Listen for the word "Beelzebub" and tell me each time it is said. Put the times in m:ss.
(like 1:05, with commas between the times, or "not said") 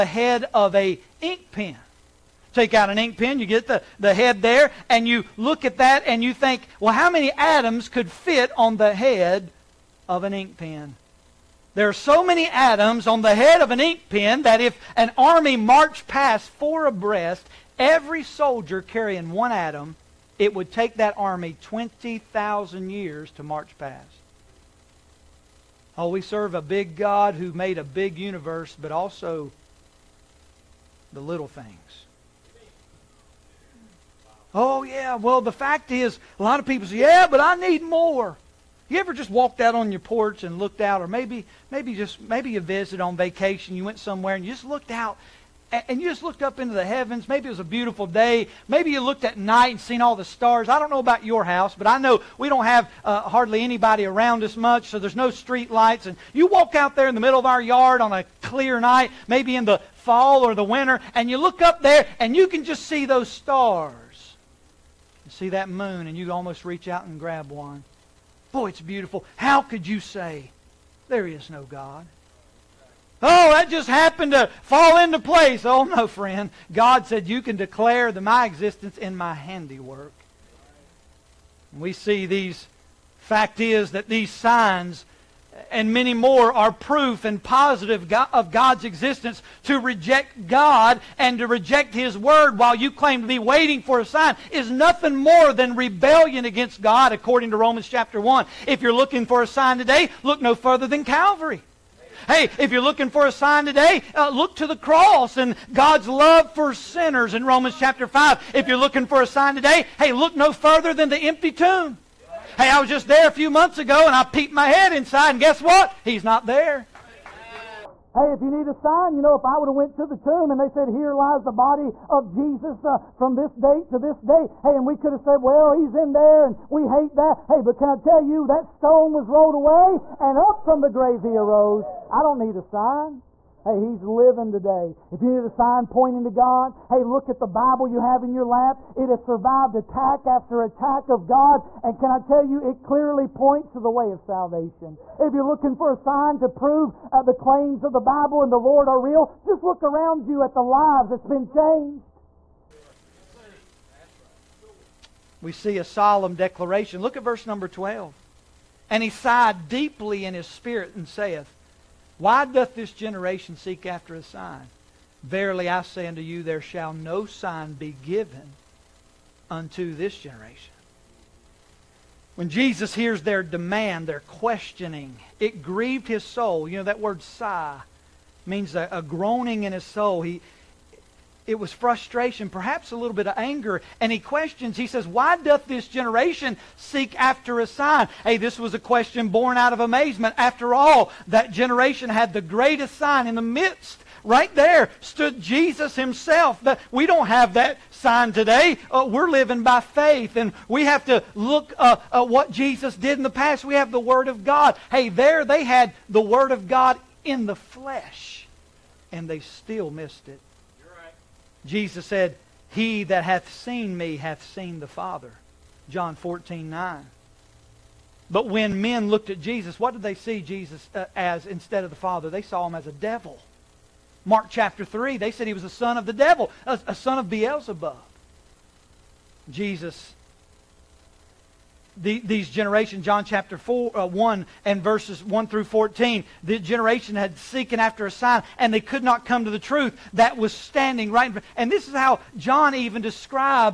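3:47.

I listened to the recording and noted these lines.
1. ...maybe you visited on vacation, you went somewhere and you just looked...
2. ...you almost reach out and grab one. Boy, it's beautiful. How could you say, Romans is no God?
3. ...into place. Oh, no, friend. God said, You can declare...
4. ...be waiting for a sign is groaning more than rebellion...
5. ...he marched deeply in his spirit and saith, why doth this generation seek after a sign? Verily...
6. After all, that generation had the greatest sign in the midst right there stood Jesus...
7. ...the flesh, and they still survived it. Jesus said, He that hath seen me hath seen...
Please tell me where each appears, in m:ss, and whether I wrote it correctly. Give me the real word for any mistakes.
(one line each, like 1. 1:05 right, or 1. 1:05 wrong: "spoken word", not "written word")
1. 0:42 right
2. 1:06 wrong: "There", not "Romans"
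3. 1:14 right
4. 1:33 wrong: "nothing", not "groaning"
5. 2:39 wrong: "sighed", not "marched"
6. 3:10 right
7. 3:27 wrong: "missed", not "survived".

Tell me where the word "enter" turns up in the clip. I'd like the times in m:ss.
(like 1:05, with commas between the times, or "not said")
not said.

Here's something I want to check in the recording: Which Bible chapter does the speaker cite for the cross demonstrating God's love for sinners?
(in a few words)
Romans chapter 5.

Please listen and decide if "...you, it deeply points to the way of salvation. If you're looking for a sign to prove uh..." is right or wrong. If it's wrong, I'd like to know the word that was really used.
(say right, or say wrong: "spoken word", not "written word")
wrong: "clearly", not "deeply".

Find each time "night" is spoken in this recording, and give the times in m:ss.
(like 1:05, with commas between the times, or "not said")
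0:49, 0:58.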